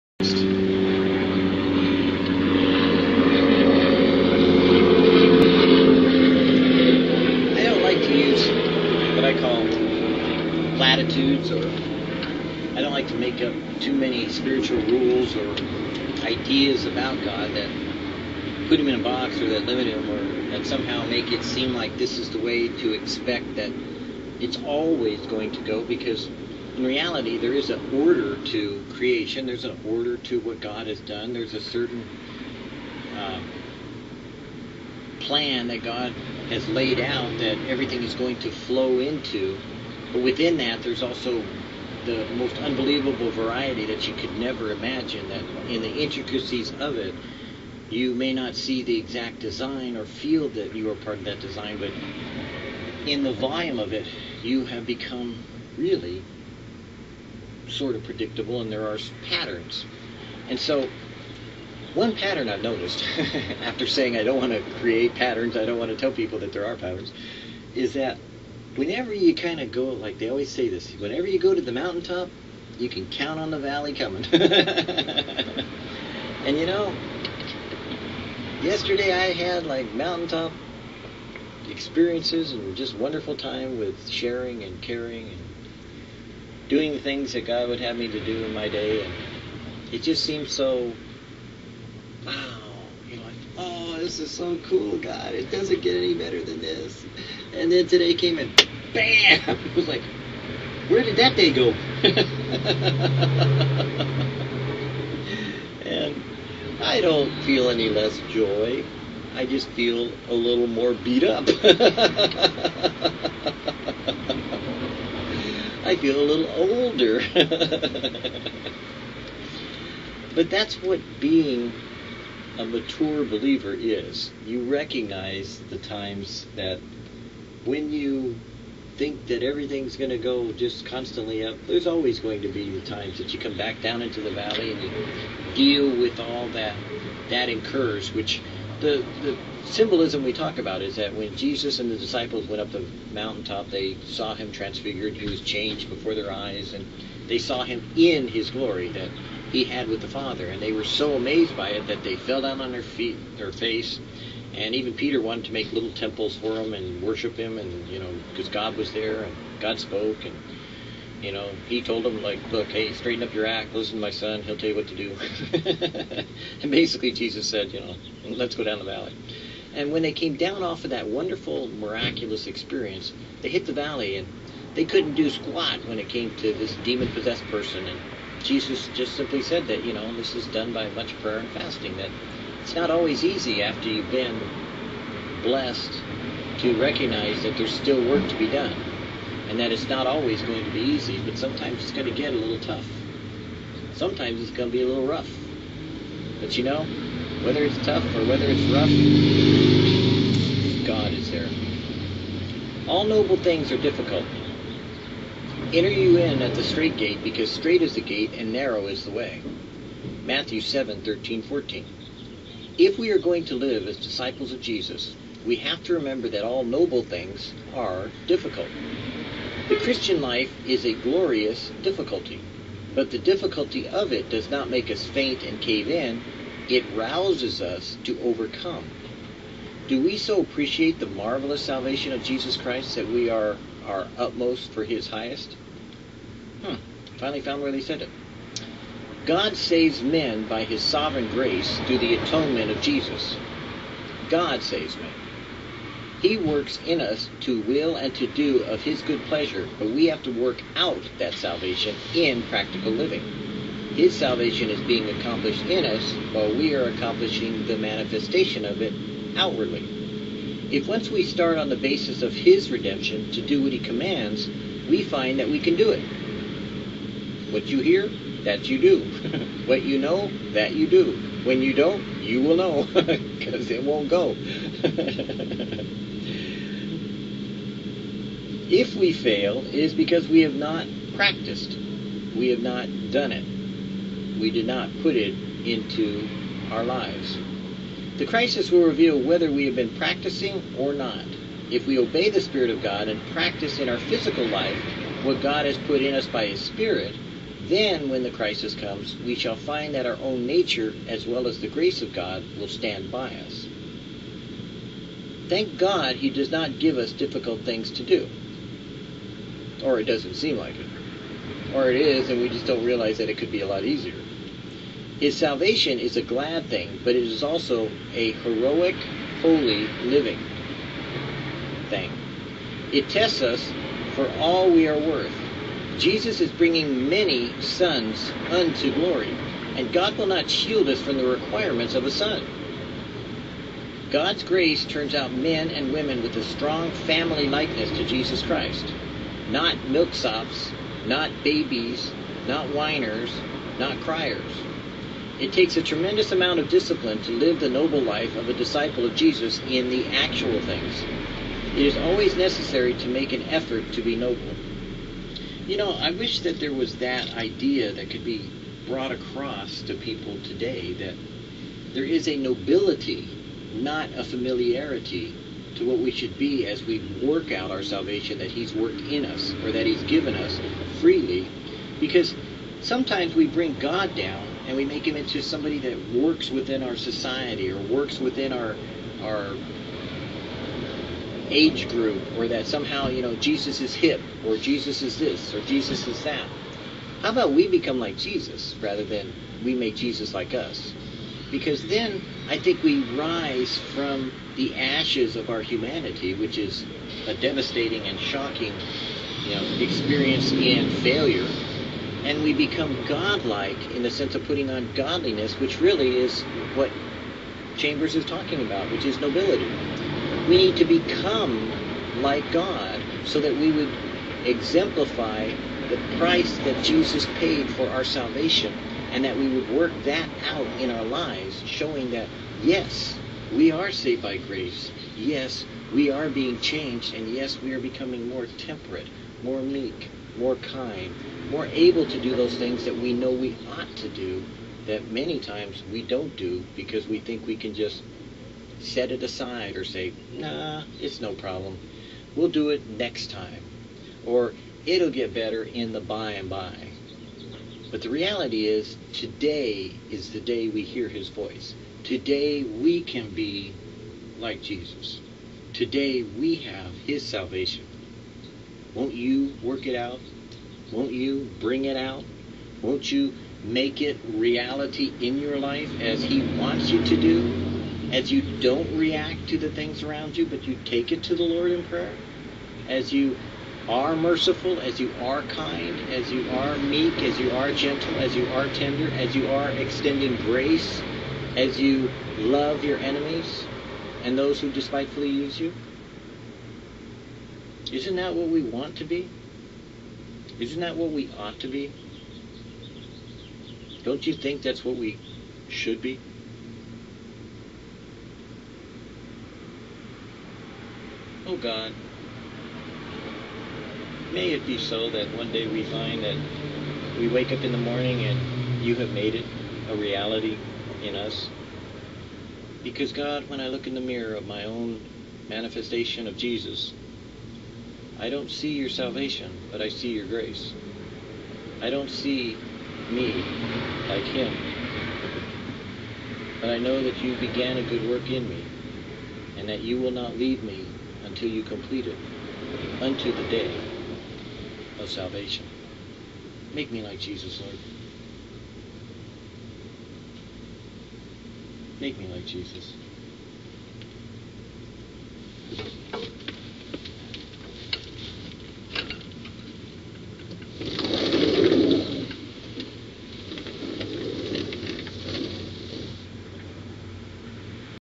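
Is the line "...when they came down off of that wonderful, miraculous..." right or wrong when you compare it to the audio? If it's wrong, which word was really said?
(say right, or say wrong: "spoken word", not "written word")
right.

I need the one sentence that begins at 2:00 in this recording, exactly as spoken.
but that's what being a mature believer is.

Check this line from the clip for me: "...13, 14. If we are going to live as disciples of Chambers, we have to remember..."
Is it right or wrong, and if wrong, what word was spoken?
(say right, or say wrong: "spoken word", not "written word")
wrong: "Jesus", not "Chambers".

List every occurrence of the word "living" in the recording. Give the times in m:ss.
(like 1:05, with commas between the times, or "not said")
4:12, 5:20.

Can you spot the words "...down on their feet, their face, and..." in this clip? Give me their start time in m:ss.
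2:32.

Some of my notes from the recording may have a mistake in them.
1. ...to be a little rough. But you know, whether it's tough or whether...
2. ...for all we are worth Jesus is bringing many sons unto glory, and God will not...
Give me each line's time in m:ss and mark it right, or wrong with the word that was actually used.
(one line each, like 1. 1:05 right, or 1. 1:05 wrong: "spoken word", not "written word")
1. 3:14 right
2. 5:24 right.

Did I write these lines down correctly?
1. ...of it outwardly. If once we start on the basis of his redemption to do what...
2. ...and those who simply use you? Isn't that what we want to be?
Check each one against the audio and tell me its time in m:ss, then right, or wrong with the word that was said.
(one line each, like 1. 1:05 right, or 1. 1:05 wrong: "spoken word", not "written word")
1. 4:18 right
2. 8:04 wrong: "despitefully", not "simply".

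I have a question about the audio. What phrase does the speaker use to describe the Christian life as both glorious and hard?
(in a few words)
A glorious difficulty.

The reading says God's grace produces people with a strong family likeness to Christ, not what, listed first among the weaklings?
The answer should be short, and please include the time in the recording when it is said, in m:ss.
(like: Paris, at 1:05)
Milksops, at 5:39.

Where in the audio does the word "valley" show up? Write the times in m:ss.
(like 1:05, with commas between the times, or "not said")
1:13, 2:14, 2:48, 2:53.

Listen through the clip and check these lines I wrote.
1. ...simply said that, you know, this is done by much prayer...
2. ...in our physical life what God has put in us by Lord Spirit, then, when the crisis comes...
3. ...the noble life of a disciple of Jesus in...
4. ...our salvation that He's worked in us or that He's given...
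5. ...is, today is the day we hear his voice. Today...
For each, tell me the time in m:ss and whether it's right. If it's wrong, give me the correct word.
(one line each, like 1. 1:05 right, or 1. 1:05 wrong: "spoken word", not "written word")
1. 2:59 right
2. 4:53 wrong: "His", not "Lord"
3. 5:47 right
4. 6:07 right
5. 7:28 right.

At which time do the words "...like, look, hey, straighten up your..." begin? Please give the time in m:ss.
2:42.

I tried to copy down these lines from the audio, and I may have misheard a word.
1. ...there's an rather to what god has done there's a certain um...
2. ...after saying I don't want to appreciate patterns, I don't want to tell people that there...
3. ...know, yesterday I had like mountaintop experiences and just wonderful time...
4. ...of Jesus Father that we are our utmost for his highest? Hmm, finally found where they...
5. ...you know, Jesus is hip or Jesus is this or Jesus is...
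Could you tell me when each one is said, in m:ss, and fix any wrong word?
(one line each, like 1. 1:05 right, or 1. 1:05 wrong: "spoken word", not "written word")
1. 0:29 wrong: "order", not "rather"
2. 1:03 wrong: "create", not "appreciate"
3. 1:16 right
4. 3:52 wrong: "Christ", not "Father"
5. 6:23 right.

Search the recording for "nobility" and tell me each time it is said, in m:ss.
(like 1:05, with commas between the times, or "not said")
6:02, 6:49.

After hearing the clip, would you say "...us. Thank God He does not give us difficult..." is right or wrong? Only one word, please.
right.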